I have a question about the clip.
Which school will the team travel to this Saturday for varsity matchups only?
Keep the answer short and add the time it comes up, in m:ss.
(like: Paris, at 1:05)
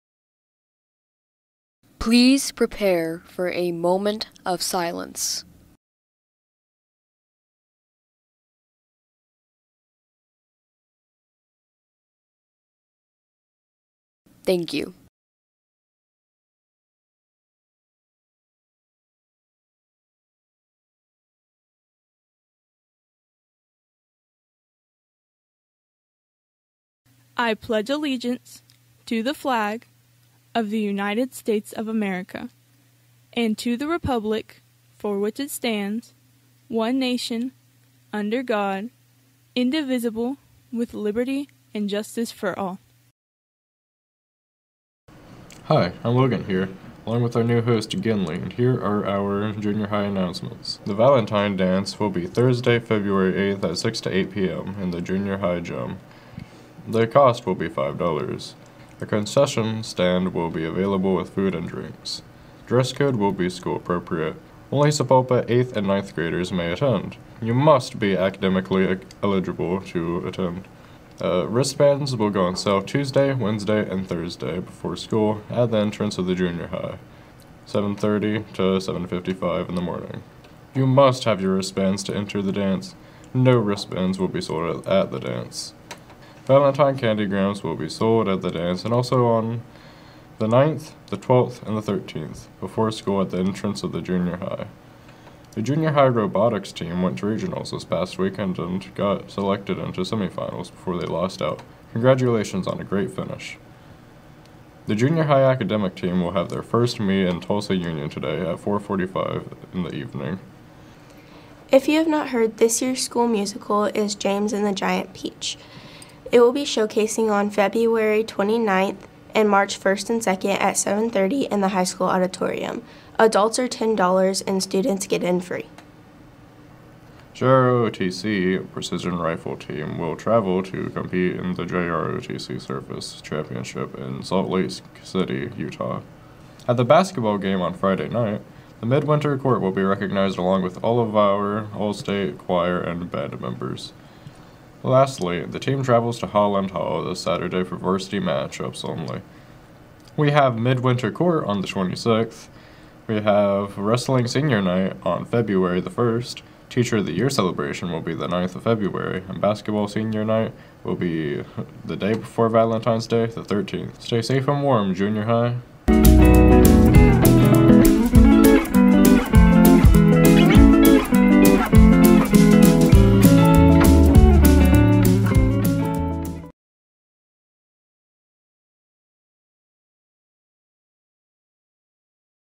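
Holland Hall, at 2:26.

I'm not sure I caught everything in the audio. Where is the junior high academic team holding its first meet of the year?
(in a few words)
Tulsa Union.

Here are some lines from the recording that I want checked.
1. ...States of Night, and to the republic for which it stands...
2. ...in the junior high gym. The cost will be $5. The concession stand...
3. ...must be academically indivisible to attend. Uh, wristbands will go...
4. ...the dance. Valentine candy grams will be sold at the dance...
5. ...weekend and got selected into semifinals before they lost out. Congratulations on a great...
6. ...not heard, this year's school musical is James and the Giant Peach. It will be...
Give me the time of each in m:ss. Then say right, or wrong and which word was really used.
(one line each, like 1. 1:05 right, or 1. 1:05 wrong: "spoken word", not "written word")
1. 0:31 wrong: "America", not "Night"
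2. 0:54 right
3. 1:07 wrong: "eligible", not "indivisible"
4. 1:25 right
5. 1:38 right
6. 1:52 right.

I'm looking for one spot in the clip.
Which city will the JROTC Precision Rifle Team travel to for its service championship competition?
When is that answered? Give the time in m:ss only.
2:14.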